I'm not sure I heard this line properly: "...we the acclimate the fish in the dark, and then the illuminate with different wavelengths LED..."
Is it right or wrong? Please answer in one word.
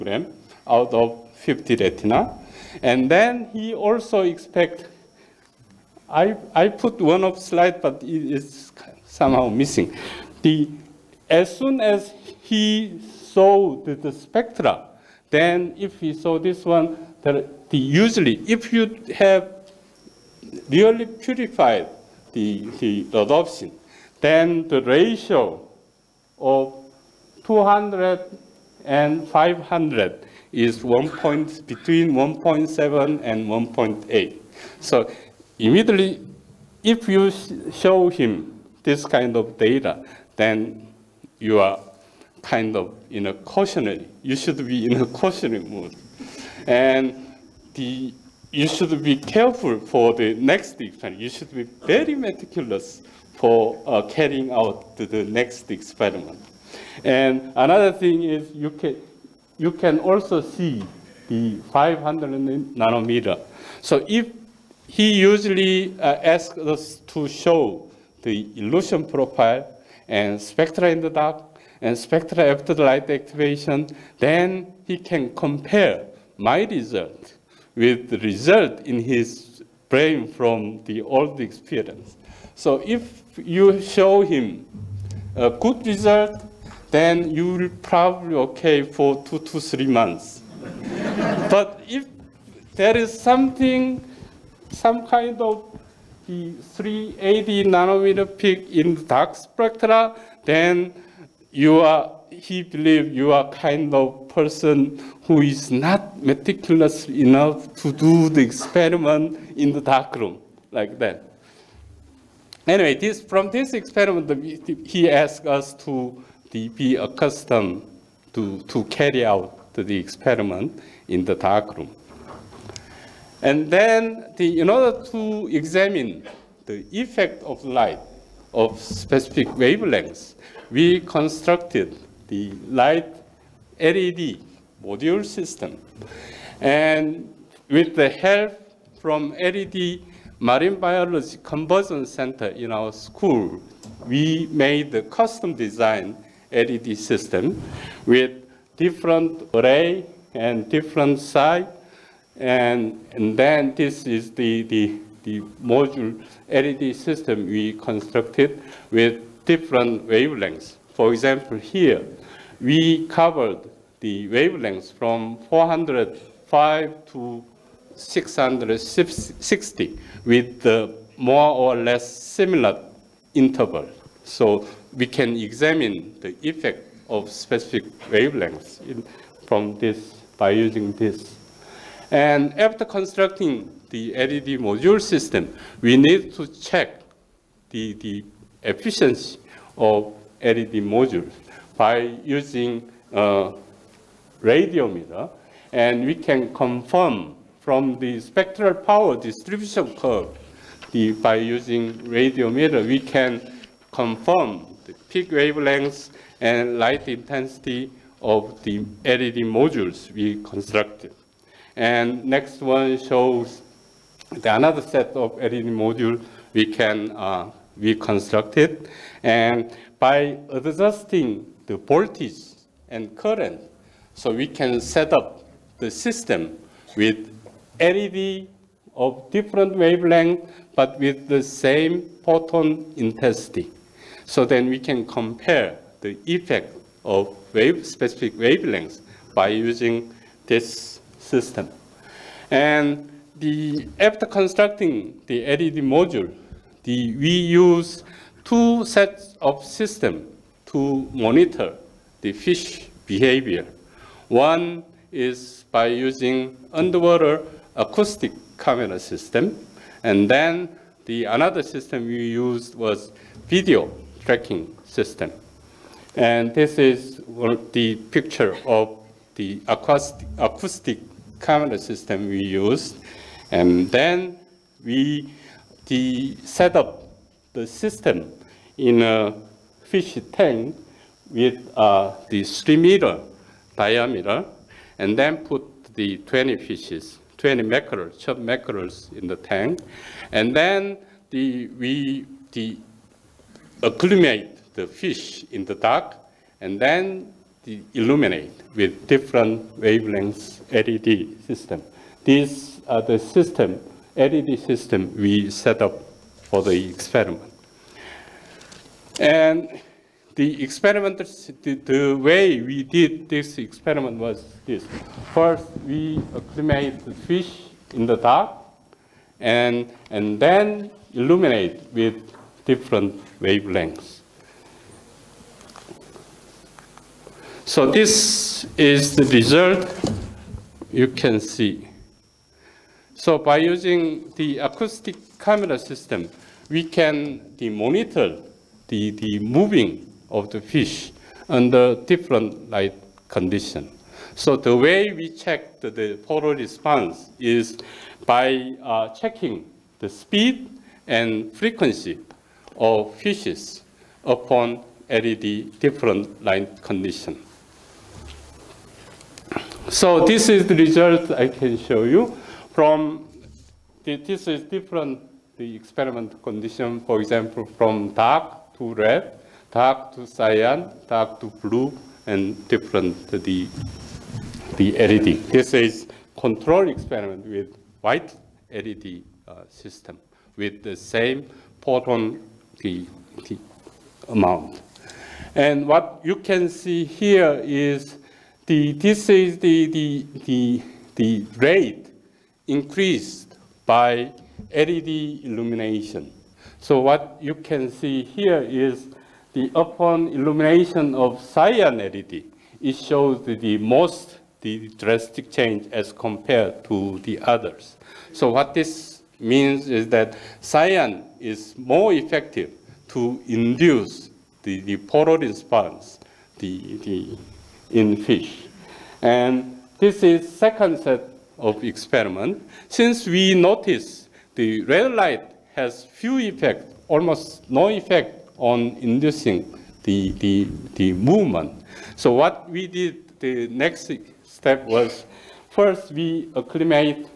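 right.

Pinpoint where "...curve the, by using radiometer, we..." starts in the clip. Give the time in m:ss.
3:19.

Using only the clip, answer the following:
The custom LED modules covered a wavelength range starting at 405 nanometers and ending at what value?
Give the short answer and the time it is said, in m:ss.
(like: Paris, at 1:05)
660, at 2:47.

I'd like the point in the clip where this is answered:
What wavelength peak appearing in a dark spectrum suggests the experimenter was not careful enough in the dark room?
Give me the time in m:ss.
1:36.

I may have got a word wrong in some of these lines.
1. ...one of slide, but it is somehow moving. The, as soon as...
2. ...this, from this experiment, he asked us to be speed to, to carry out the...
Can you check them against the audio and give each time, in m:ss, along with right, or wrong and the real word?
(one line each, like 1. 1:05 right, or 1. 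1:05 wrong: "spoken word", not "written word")
1. 0:07 wrong: "missing", not "moving"
2. 1:53 wrong: "accustomed", not "speed".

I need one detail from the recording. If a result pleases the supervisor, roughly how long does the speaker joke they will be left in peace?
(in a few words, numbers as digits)
two to three months.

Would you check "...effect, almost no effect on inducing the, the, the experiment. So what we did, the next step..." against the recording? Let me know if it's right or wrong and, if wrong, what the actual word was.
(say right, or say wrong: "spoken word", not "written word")
wrong: "movement", not "experiment".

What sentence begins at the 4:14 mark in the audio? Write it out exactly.
One is by using underwater acoustic camera system.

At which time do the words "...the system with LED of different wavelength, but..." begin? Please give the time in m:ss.
3:45.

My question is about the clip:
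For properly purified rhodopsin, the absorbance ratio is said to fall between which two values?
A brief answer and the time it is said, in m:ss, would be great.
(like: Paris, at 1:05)
1.7 and 1.8, at 0:32.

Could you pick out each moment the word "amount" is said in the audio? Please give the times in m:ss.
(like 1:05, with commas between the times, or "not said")
6:24.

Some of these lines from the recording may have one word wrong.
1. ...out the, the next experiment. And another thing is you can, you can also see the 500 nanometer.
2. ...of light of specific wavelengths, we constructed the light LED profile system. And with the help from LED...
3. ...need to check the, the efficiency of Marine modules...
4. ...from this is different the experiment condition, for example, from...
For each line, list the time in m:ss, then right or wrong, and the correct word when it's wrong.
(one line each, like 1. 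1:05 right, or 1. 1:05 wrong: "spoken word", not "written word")
1. 0:54 right
2. 2:07 wrong: "module", not "profile"
3. 3:05 wrong: "LED", not "Marine"
4. 6:02 right.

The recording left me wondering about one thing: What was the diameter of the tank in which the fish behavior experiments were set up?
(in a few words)
3 meters.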